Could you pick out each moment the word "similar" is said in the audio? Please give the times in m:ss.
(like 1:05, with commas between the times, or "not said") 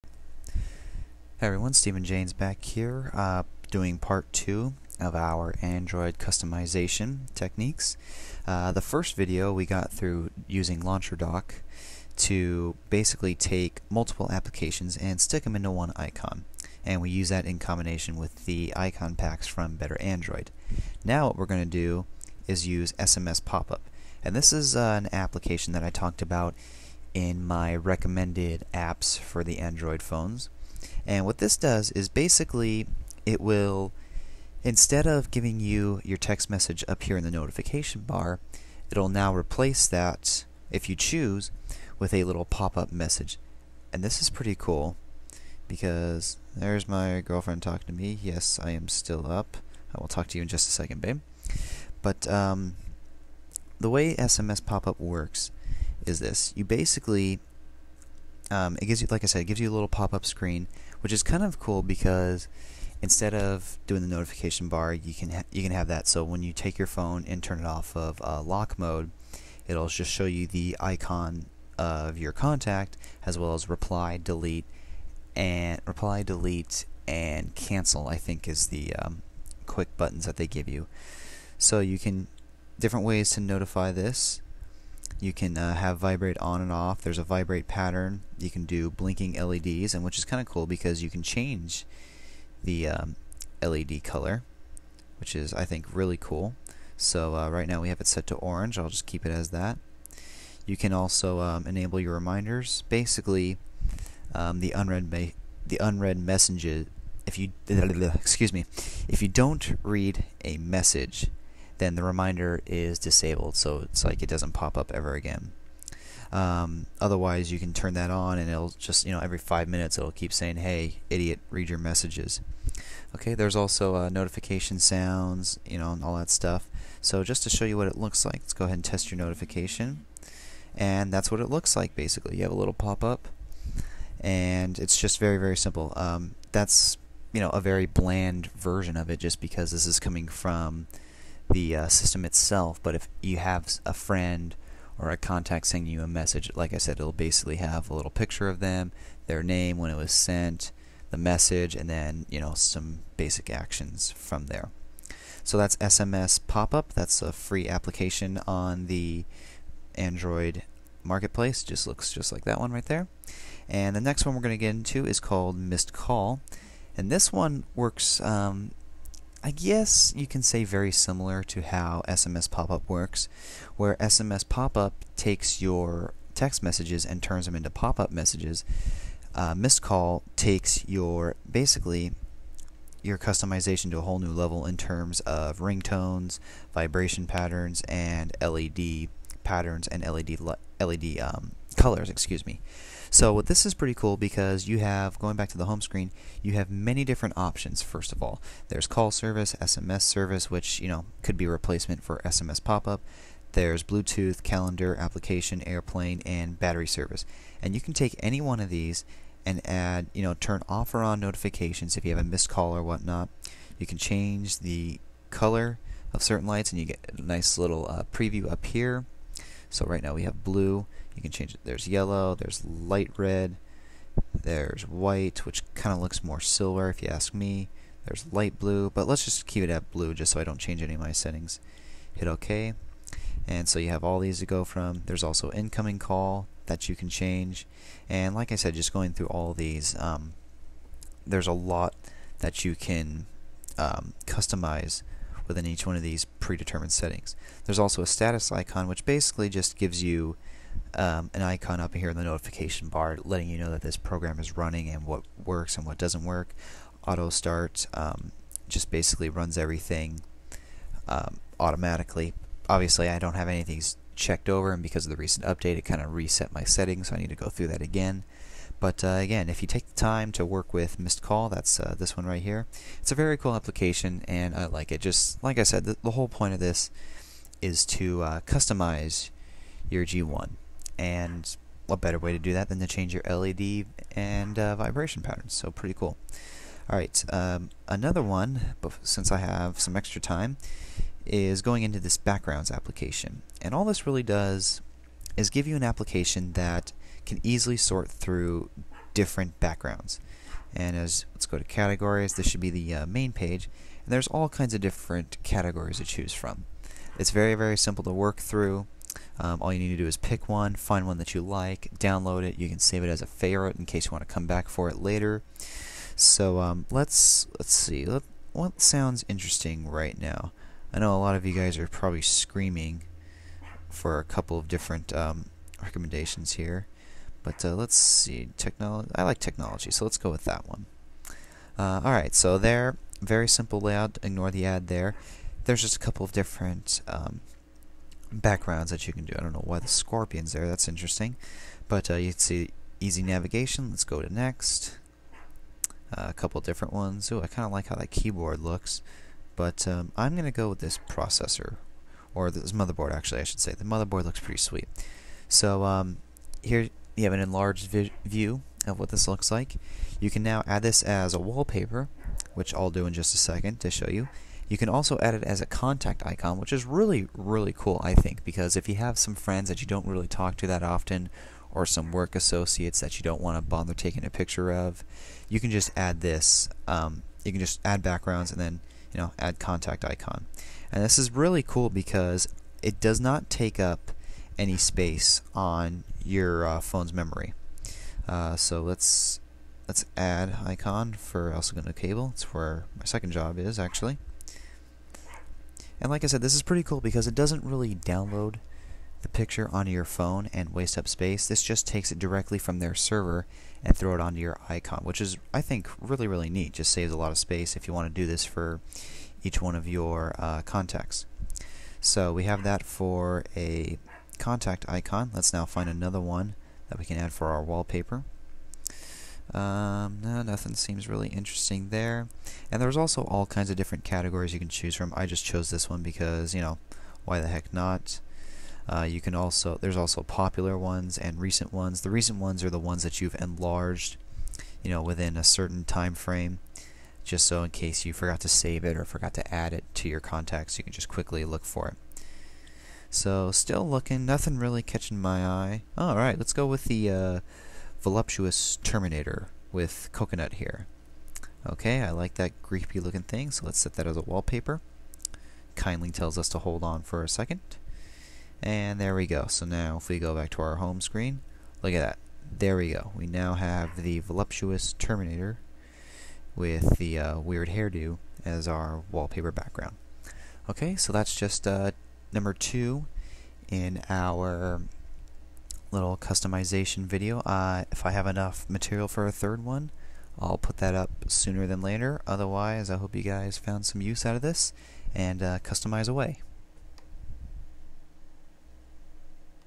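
2:50.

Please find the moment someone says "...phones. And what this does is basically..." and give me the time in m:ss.
0:30.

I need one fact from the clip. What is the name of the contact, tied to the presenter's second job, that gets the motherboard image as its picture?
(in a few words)
cable.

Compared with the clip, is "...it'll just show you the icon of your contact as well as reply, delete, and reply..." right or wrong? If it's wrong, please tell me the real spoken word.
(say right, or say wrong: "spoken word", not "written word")
right.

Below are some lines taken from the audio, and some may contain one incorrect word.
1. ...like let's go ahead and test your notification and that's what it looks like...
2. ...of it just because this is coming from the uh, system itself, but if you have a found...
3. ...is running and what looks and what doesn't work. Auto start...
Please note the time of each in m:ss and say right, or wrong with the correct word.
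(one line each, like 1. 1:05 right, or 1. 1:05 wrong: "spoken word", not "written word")
1. 2:08 right
2. 2:18 wrong: "friend", not "found"
3. 4:14 wrong: "works", not "looks".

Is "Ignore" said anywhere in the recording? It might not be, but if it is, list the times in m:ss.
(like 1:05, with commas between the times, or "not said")
5:34.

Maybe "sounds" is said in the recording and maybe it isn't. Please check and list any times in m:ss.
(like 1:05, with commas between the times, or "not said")
2:04, 5:18.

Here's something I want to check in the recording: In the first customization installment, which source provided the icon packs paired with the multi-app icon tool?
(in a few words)
Better Android.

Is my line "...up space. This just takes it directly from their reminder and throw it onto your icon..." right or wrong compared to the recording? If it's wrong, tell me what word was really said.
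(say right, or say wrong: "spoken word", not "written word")
wrong: "server", not "reminder".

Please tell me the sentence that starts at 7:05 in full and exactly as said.
I just chose this one because, you know, why the heck not?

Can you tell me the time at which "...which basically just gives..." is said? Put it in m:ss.
4:08.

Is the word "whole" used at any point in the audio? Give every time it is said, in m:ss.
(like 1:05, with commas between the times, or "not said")
3:04, 4:36.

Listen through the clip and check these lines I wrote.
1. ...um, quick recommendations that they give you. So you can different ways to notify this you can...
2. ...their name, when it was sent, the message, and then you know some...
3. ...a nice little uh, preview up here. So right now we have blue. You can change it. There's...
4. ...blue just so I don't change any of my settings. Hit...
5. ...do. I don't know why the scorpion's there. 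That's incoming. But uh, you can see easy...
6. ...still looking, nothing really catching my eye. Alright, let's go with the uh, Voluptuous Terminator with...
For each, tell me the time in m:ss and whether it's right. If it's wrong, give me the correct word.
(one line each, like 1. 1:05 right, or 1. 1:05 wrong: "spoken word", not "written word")
1. 1:18 wrong: "buttons", not "recommendations"
2. 2:29 right
3. 3:37 right
4. 3:49 right
5. 5:39 wrong: "interesting", not "incoming"
6. 7:23 right.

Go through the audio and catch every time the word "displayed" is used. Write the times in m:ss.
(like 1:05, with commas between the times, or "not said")
not said.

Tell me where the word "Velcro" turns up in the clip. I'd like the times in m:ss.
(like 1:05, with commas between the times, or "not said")
not said.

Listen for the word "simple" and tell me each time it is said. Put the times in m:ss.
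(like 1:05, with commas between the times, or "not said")
2:15, 5:07, 5:33.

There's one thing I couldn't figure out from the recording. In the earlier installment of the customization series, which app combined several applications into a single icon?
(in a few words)
Launcher Dock.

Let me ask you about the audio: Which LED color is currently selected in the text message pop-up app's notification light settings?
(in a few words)
orange.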